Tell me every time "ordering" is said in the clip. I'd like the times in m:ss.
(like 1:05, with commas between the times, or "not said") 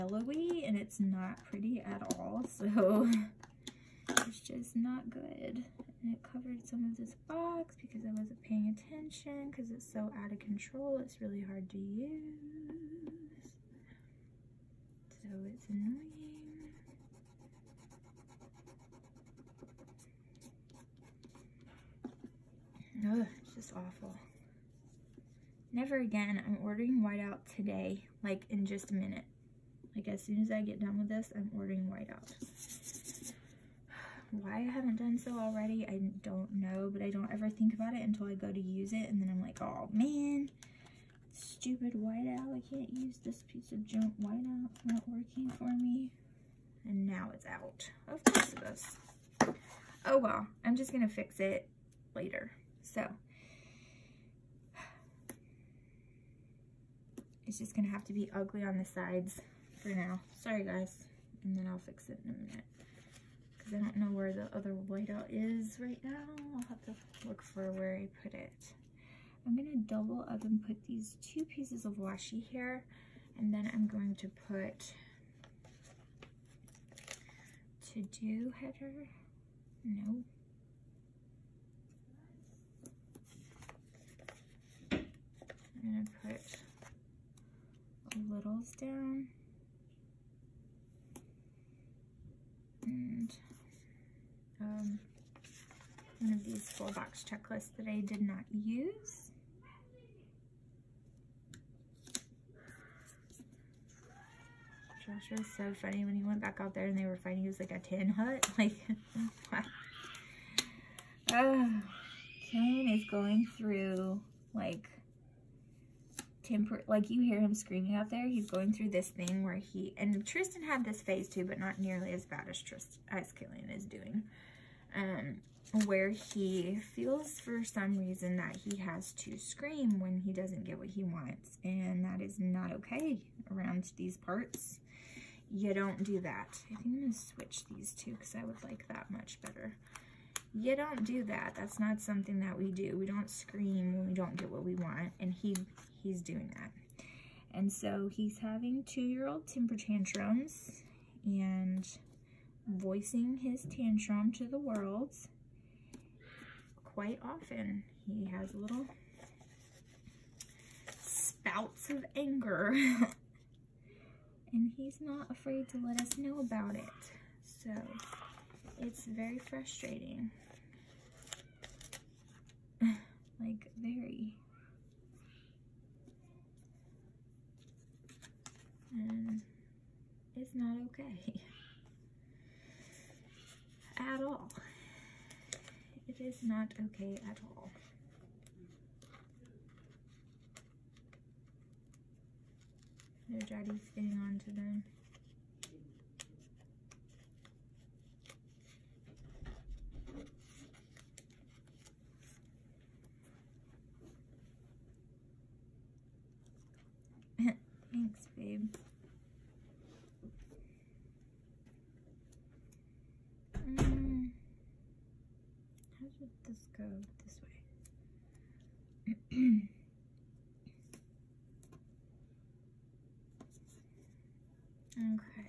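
0:26, 0:31.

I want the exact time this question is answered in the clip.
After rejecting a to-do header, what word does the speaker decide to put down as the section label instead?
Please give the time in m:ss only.
1:28.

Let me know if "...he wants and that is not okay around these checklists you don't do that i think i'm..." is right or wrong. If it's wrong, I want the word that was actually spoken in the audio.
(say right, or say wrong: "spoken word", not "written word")
wrong: "parts", not "checklists".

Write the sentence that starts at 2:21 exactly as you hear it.
That's not something that we do.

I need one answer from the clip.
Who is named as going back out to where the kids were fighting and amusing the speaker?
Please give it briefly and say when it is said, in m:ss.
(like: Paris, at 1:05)
Josh, at 1:45.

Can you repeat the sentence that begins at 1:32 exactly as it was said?
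And um, one of these full box checklists that I did not use.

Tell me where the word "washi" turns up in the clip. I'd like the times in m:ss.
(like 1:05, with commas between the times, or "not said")
1:11.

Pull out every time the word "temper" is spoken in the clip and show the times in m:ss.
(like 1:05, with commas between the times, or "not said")
1:56, 2:29.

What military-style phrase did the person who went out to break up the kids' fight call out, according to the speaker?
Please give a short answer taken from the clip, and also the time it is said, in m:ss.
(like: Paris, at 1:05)
tin hut, at 1:47.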